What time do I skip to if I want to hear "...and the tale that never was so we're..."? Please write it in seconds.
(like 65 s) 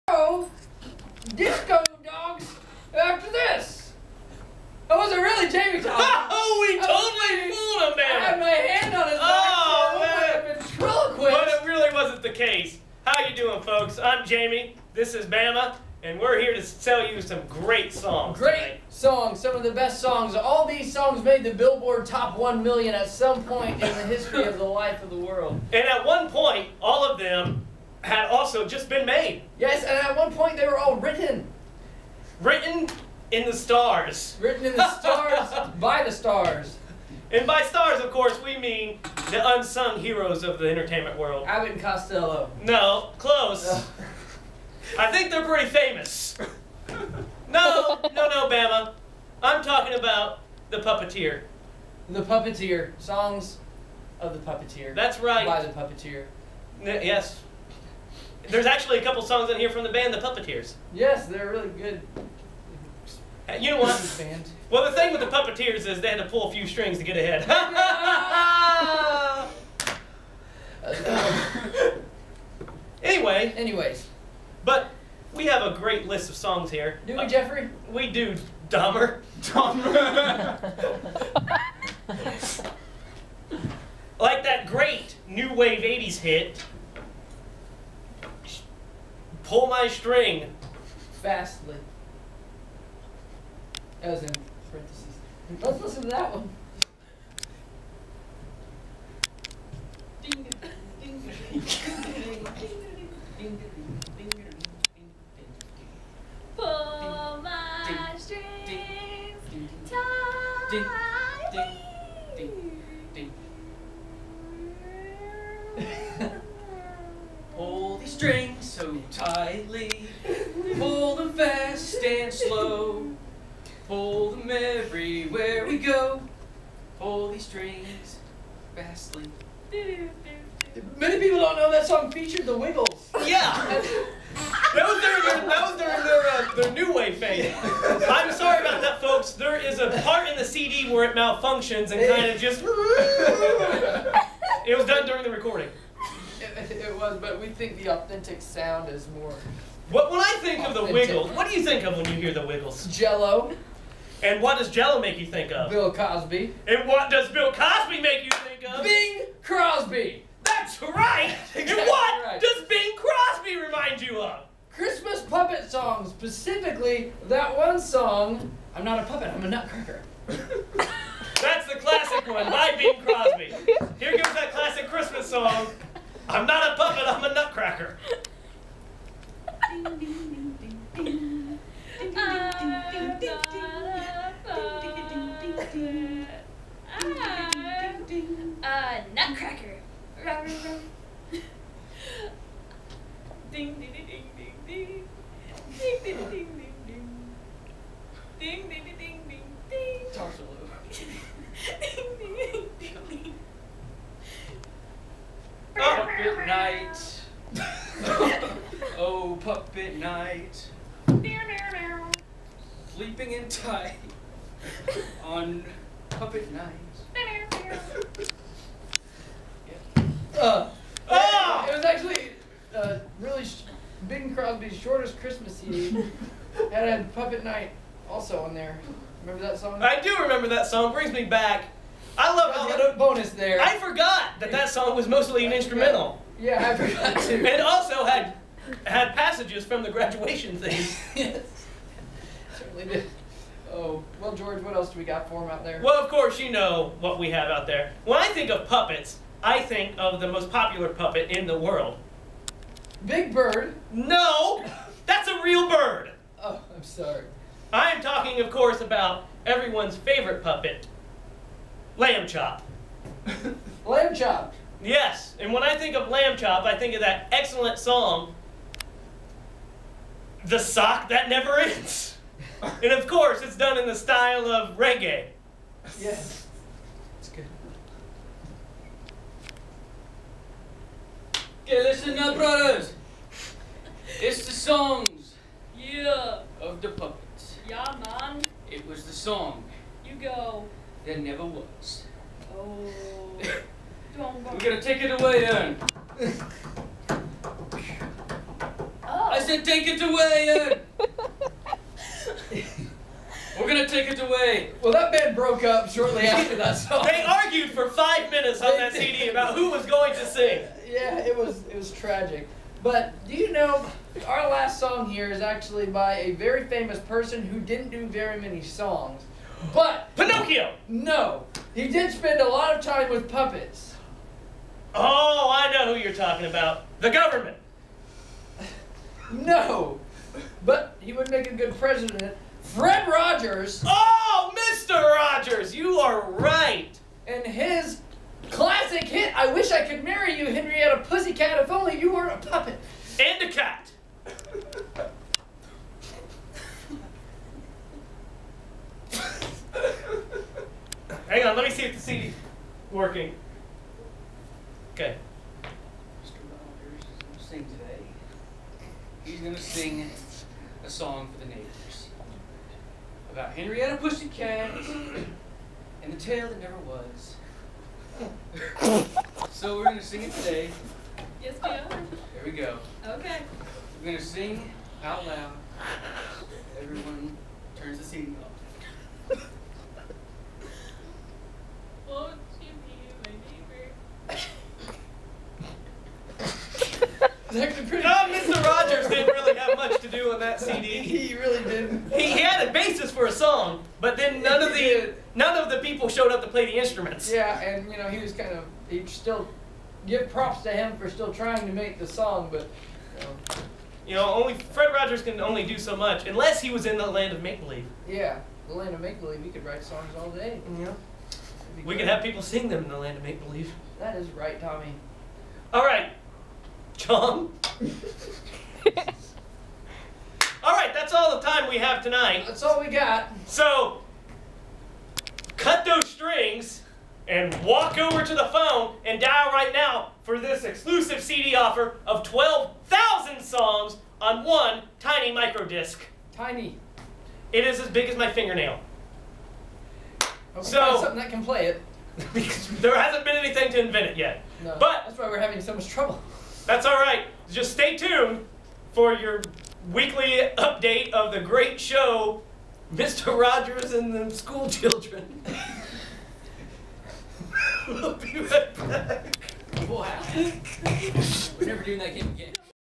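366 s.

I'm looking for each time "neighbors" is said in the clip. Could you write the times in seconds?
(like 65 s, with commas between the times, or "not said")
361 s, 384 s.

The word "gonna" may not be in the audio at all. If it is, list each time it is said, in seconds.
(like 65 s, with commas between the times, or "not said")
294 s, 303 s.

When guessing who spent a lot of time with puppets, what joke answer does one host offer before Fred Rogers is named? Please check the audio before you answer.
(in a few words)
The government.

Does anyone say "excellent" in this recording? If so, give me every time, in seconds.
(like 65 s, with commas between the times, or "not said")
267 s.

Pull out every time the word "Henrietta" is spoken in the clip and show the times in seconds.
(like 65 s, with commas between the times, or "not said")
340 s, 363 s.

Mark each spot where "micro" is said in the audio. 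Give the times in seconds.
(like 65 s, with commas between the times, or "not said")
435 s.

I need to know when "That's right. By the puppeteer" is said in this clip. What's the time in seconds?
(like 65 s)
54 s.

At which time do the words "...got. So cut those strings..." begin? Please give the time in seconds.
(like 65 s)
422 s.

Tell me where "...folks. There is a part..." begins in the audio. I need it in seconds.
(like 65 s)
139 s.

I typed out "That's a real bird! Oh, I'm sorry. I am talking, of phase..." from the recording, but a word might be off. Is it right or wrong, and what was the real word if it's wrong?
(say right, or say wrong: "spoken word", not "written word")
wrong: "course", not "phase".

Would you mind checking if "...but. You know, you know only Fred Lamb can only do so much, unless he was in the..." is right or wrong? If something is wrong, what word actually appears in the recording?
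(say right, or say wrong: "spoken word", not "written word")
wrong: "Rogers", not "Lamb".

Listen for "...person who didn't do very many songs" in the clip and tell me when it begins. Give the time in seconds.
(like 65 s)
316 s.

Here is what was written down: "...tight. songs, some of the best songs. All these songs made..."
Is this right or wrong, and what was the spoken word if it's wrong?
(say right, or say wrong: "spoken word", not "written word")
wrong: "tonight", not "tight".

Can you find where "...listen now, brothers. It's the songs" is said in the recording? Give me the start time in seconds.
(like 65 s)
281 s.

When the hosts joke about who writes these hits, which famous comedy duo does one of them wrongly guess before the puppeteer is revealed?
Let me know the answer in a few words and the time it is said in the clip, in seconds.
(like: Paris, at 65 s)
Abbott and Costello, at 41 s.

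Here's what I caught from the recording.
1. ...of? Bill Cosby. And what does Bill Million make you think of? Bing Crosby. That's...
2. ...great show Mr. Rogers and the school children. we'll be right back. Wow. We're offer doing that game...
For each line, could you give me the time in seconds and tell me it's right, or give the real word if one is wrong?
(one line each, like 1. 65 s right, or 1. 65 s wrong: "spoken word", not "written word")
1. 155 s wrong: "Cosby", not "Million"
2. 451 s wrong: "never", not "offer".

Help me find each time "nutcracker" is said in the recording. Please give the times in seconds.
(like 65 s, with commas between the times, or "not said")
169 s, 189 s.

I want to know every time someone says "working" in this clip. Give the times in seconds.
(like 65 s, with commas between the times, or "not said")
352 s.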